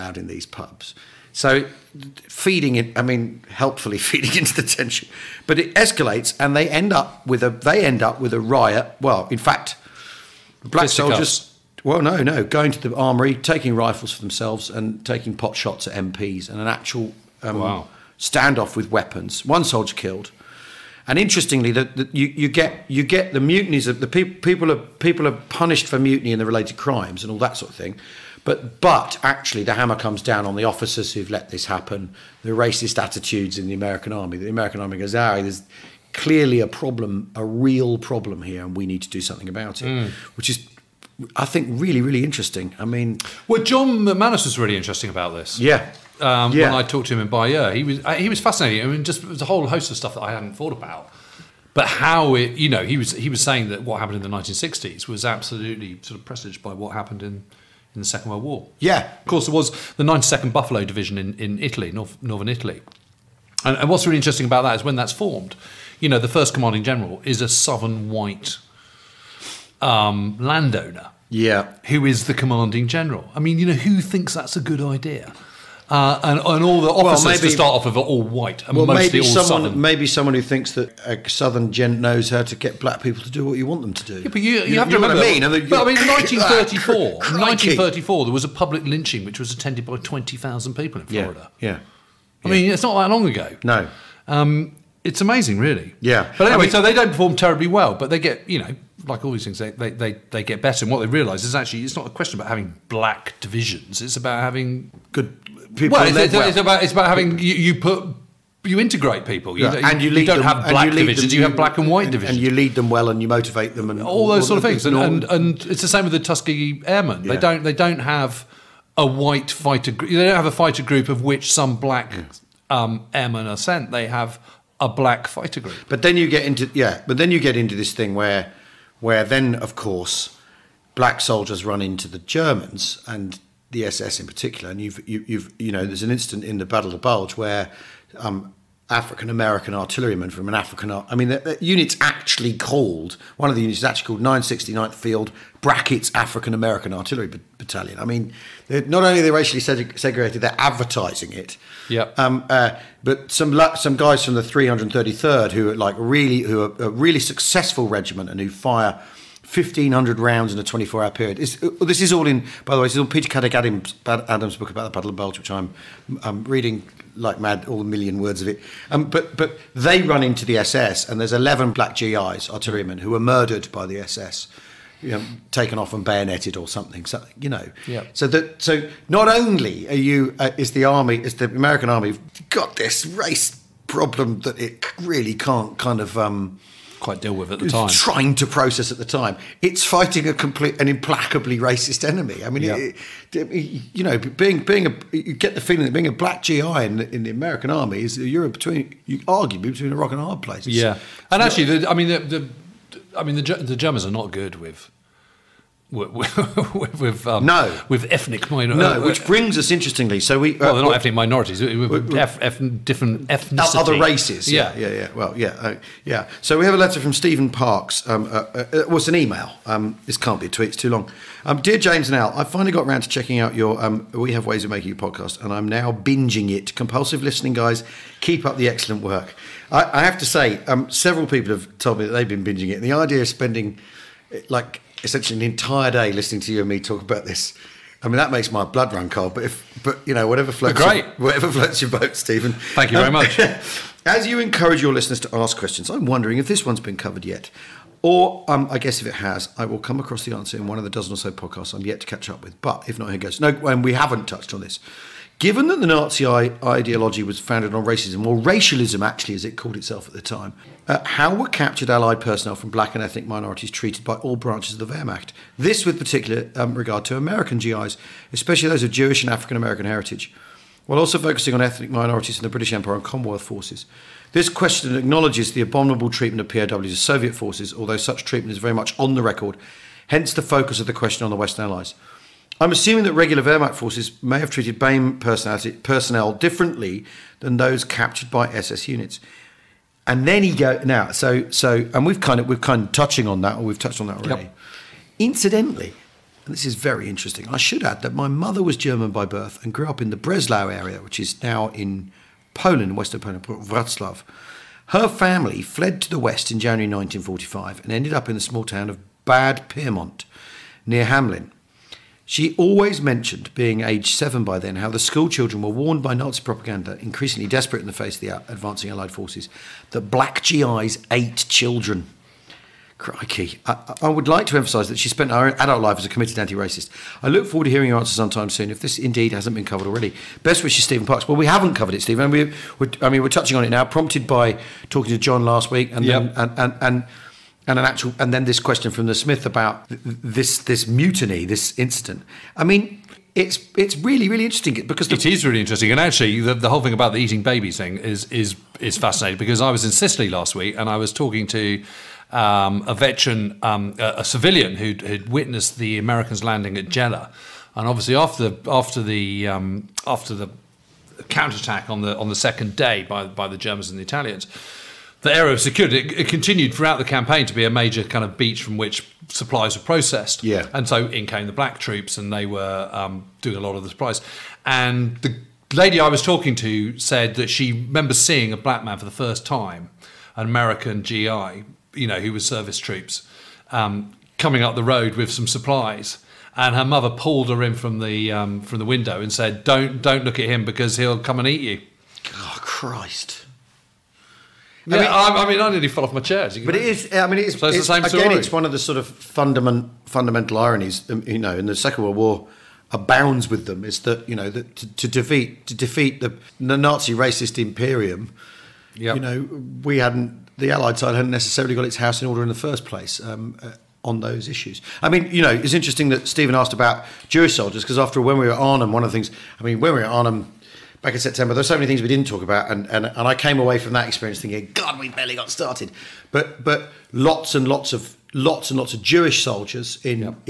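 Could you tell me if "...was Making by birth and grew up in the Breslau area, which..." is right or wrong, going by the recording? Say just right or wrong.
wrong.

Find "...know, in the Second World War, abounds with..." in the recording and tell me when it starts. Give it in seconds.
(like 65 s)
401 s.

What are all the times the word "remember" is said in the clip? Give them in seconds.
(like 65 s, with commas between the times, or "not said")
84 s, 377 s.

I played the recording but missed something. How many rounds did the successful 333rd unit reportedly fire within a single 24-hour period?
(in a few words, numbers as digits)
1,500.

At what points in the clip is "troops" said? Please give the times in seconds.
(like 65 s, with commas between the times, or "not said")
371 s, 382 s.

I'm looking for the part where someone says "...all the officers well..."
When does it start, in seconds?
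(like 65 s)
76 s.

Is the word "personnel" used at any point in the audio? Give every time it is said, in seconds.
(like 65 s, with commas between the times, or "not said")
262 s, 285 s.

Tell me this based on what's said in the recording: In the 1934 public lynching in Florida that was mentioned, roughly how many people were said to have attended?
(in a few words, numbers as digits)
20,000.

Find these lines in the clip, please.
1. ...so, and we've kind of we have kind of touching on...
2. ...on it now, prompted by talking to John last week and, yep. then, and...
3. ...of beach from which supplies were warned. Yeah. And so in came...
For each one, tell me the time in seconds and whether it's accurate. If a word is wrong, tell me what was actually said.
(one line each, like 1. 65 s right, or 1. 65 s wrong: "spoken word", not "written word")
1. 291 s right
2. 333 s right
3. 368 s wrong: "processed", not "warned".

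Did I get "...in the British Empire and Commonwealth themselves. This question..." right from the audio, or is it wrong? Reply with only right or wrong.
wrong.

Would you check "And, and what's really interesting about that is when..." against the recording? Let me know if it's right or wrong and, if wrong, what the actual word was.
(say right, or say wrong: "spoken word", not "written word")
right.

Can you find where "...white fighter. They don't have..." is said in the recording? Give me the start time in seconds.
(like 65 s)
119 s.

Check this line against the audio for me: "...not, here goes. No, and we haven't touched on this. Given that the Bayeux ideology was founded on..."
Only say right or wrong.
wrong.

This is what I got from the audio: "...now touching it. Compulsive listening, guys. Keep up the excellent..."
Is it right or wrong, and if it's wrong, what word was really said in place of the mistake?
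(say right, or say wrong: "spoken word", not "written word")
wrong: "binging", not "touching".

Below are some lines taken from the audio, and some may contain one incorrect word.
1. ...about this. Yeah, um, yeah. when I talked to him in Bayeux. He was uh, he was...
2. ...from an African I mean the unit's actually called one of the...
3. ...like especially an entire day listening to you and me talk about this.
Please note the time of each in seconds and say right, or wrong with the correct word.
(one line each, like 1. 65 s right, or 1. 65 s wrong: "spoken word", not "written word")
1. 45 s right
2. 140 s right
3. 234 s wrong: "essentially", not "especially".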